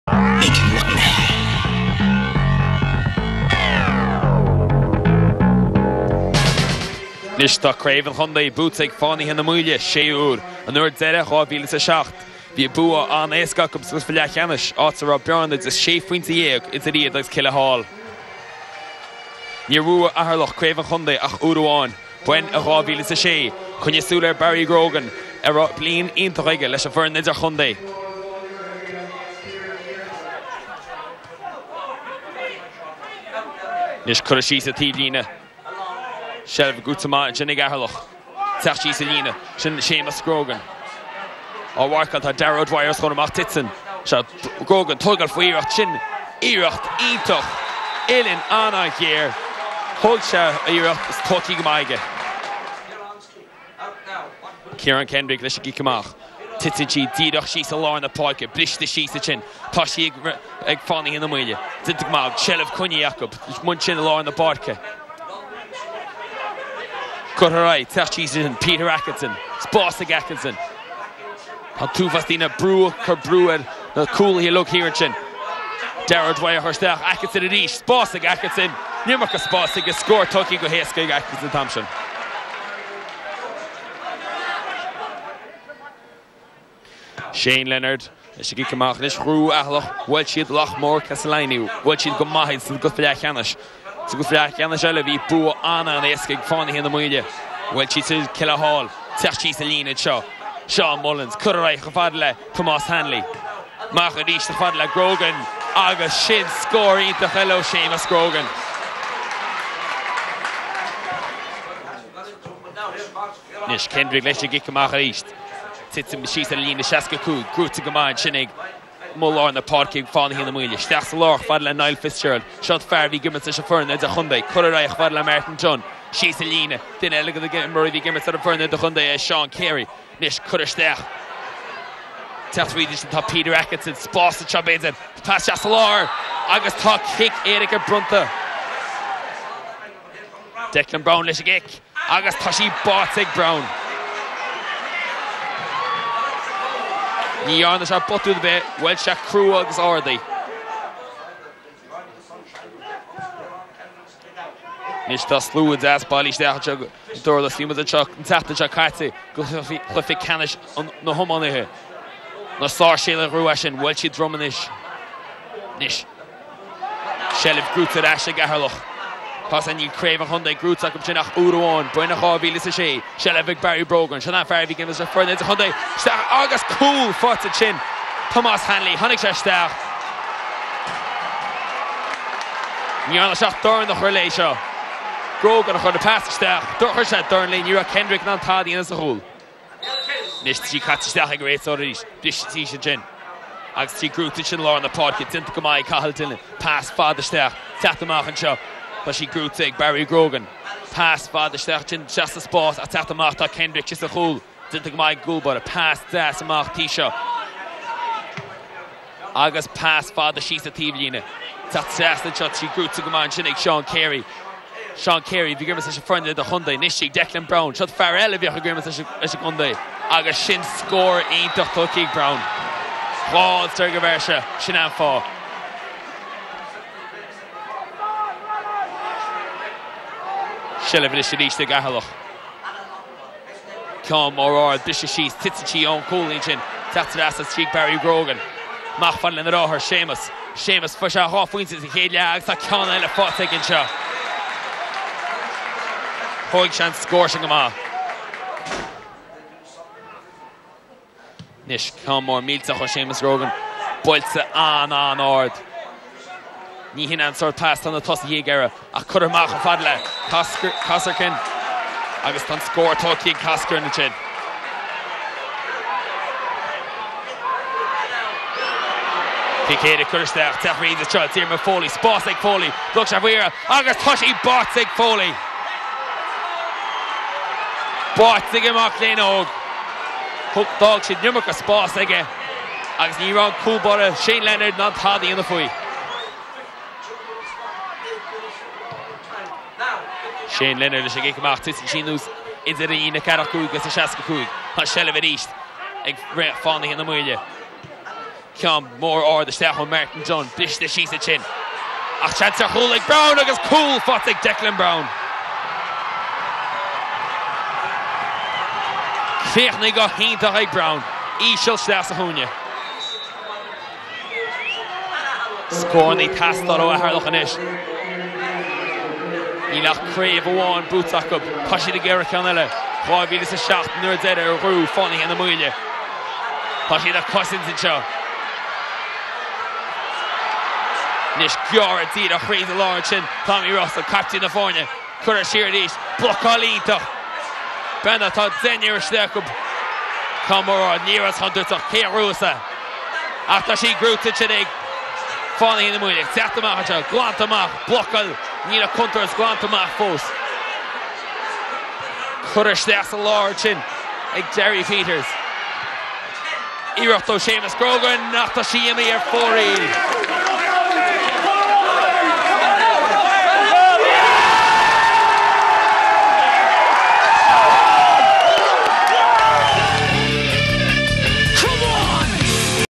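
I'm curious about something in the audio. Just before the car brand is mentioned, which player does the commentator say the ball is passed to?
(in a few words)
Neil Fitzgerald.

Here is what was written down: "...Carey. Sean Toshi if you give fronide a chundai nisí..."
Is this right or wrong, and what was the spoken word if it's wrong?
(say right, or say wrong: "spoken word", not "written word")
wrong: "Carey", not "Toshi".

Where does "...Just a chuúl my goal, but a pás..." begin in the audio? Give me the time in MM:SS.
03:23.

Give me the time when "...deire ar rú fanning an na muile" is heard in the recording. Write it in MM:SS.
05:24.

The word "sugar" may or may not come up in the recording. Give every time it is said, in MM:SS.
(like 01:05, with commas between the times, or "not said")
not said.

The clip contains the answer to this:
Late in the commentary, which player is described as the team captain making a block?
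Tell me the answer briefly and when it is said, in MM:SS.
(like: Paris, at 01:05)
Tommy Ross, at 05:33.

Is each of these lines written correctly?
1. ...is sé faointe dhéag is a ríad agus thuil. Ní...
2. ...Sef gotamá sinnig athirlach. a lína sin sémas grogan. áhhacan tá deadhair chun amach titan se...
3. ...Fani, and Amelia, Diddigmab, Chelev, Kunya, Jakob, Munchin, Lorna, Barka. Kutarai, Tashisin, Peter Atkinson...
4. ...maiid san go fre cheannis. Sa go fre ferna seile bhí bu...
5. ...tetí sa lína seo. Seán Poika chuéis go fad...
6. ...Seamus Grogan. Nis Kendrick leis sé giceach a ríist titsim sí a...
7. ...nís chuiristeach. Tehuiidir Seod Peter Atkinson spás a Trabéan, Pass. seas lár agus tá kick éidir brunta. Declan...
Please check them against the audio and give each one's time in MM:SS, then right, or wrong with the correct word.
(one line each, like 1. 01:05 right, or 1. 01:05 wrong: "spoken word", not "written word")
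1. 00:15 wrong: "ciileáil", not "thuil"
2. 00:36 wrong: "gahallch", not "athirlach"
3. 01:00 right
4. 01:32 wrong: "cheanna", not "ferna"
5. 01:39 wrong: "Mullins", not "Poika"
6. 01:47 right
7. 02:10 wrong: "Top", not "Seod".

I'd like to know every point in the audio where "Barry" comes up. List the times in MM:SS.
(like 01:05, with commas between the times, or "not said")
00:24, 02:53, 03:19, 03:57.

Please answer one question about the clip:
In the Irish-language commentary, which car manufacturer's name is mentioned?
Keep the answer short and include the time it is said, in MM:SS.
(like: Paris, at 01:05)
Hyundai, at 02:04.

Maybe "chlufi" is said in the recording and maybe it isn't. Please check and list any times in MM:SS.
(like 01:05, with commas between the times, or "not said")
02:39.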